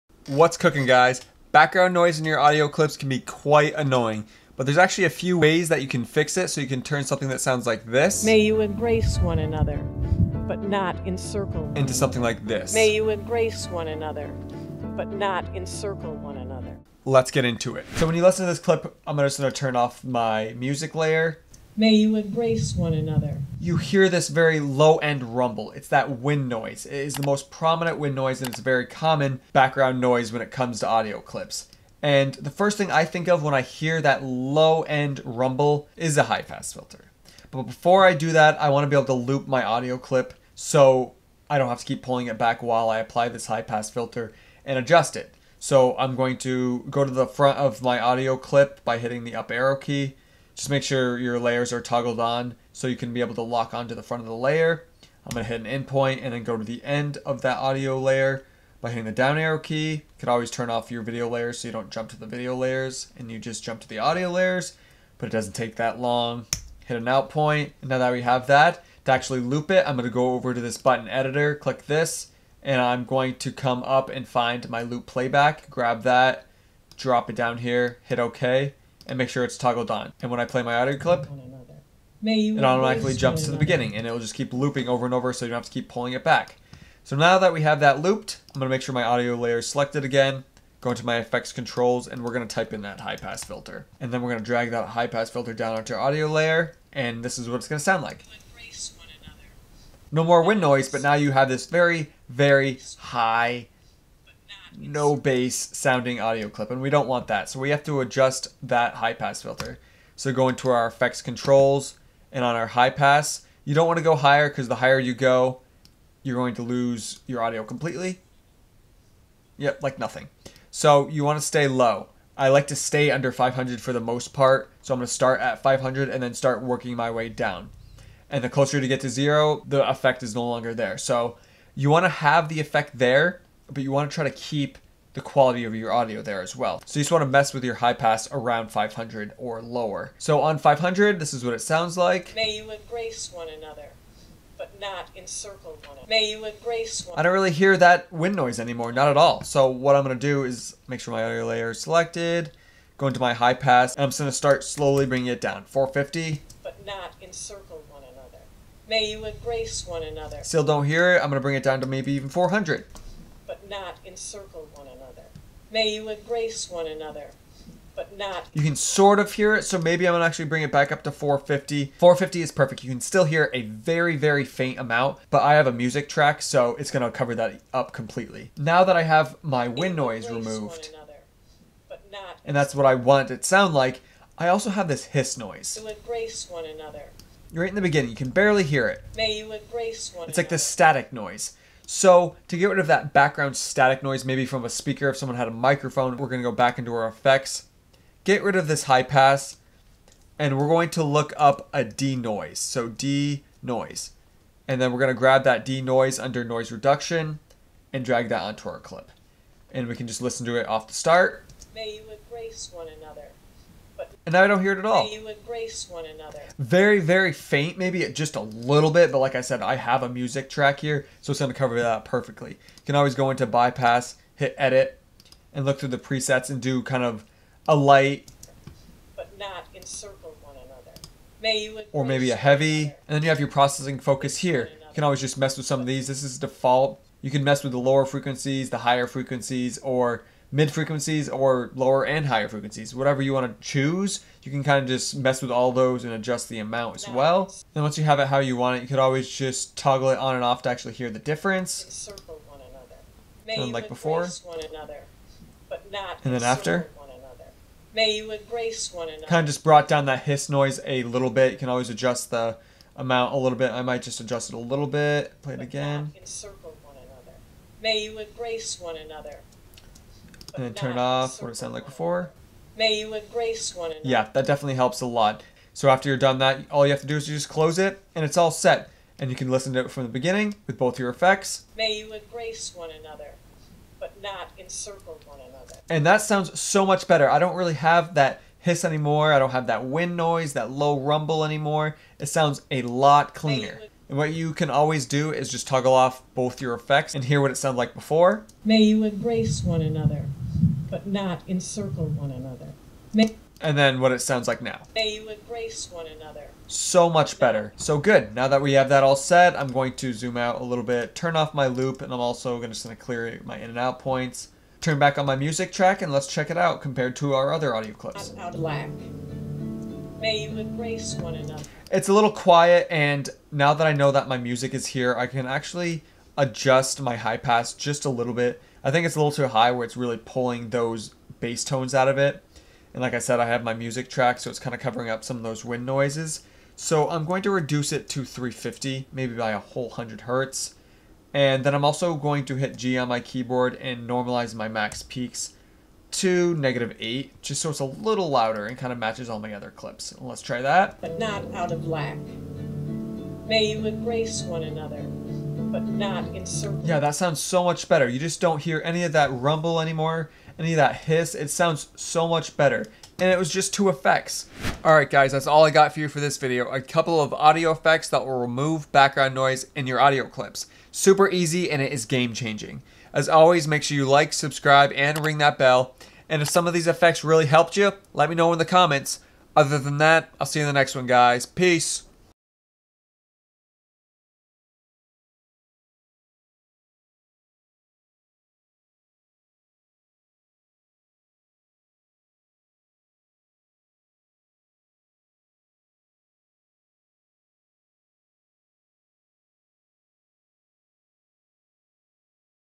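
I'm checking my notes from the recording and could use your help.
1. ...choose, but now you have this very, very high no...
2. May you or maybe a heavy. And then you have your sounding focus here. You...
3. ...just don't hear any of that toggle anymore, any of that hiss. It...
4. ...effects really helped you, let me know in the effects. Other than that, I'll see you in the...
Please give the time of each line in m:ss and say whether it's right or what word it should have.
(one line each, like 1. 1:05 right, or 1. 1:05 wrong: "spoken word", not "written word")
1. 1:40 wrong: "noise", not "choose"
2. 3:51 wrong: "processing", not "sounding"
3. 5:58 wrong: "rumble", not "toggle"
4. 6:16 wrong: "comments", not "effects".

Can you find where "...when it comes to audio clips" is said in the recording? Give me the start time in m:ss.
0:30.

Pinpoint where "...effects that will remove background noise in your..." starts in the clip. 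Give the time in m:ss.
6:07.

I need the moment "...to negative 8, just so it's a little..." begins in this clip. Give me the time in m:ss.
5:46.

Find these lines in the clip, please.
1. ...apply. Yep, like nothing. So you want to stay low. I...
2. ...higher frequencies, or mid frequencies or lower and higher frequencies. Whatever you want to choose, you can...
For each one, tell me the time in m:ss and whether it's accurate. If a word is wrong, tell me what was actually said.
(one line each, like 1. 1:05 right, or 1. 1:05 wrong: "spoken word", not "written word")
1. 1:57 wrong: "completely", not "apply"
2. 3:58 right.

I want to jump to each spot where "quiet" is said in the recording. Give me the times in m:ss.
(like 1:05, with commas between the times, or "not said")
5:22.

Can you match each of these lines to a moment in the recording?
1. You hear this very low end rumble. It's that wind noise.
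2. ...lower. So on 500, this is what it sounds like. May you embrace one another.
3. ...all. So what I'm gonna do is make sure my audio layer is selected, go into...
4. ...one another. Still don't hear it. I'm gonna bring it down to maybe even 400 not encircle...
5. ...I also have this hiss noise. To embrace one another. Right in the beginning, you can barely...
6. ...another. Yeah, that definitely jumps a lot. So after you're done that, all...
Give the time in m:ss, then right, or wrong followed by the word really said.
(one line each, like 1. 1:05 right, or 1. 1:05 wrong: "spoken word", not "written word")
1. 0:23 right
2. 2:19 right
3. 2:29 right
4. 2:39 right
5. 3:04 right
6. 4:33 wrong: "helps", not "jumps".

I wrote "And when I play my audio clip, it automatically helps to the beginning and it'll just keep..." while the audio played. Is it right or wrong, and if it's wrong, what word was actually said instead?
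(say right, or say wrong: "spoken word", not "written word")
wrong: "jumps", not "helps".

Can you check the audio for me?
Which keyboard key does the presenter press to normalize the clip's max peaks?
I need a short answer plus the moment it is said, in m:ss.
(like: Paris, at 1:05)
G, at 5:42.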